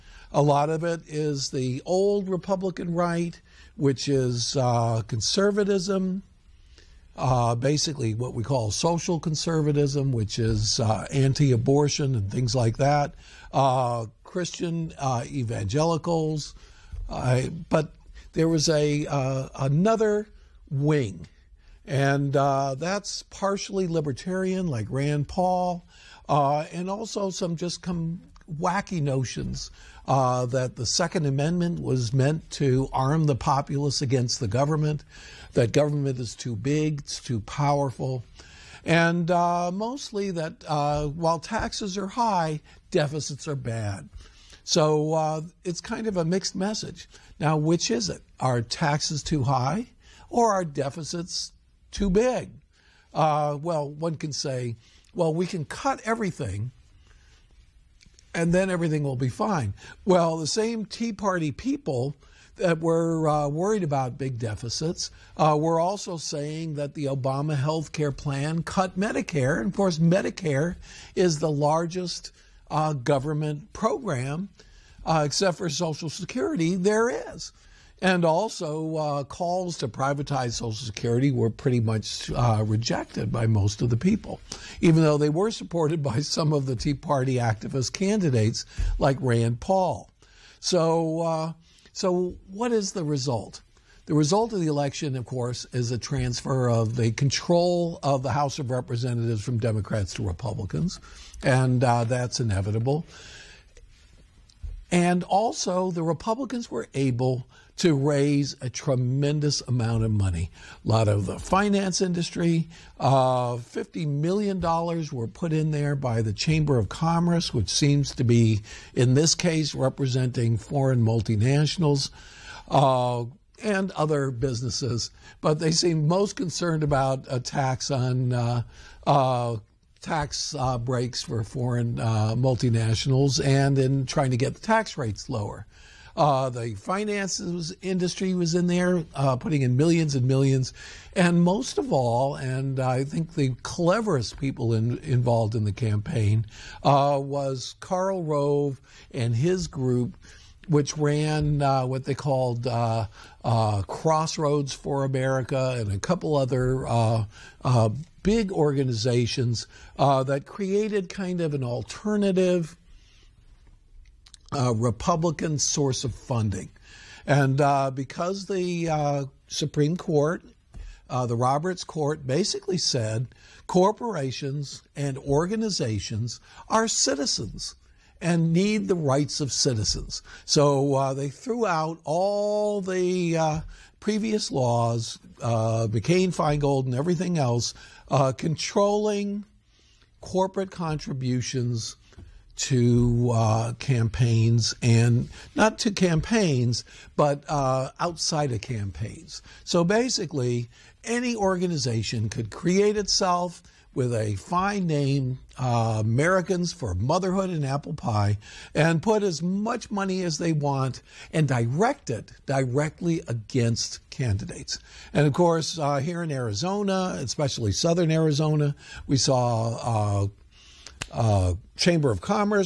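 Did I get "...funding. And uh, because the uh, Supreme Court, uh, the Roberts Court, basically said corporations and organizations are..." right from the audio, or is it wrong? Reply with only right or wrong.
right.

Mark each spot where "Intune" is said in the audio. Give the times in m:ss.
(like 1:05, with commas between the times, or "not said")
not said.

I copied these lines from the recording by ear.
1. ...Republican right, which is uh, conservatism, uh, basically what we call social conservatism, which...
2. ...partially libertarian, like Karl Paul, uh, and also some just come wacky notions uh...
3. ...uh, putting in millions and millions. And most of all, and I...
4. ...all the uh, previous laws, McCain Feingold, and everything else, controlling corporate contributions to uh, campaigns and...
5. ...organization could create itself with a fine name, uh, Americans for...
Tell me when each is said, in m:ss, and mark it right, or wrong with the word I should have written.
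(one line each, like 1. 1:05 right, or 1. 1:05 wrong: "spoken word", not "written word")
1. 0:02 right
2. 0:23 wrong: "Rand", not "Karl"
3. 2:19 right
4. 3:02 right
5. 3:21 right.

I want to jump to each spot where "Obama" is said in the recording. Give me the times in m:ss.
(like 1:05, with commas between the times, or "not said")
1:07.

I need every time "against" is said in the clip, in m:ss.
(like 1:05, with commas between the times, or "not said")
0:34, 3:33.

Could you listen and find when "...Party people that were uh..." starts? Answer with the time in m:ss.
1:01.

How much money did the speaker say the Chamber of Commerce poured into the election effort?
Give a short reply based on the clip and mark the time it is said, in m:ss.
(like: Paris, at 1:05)
$50 million, at 1:53.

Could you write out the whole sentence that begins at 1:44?
And also, the Republicans were able to raise a tremendous amount of money.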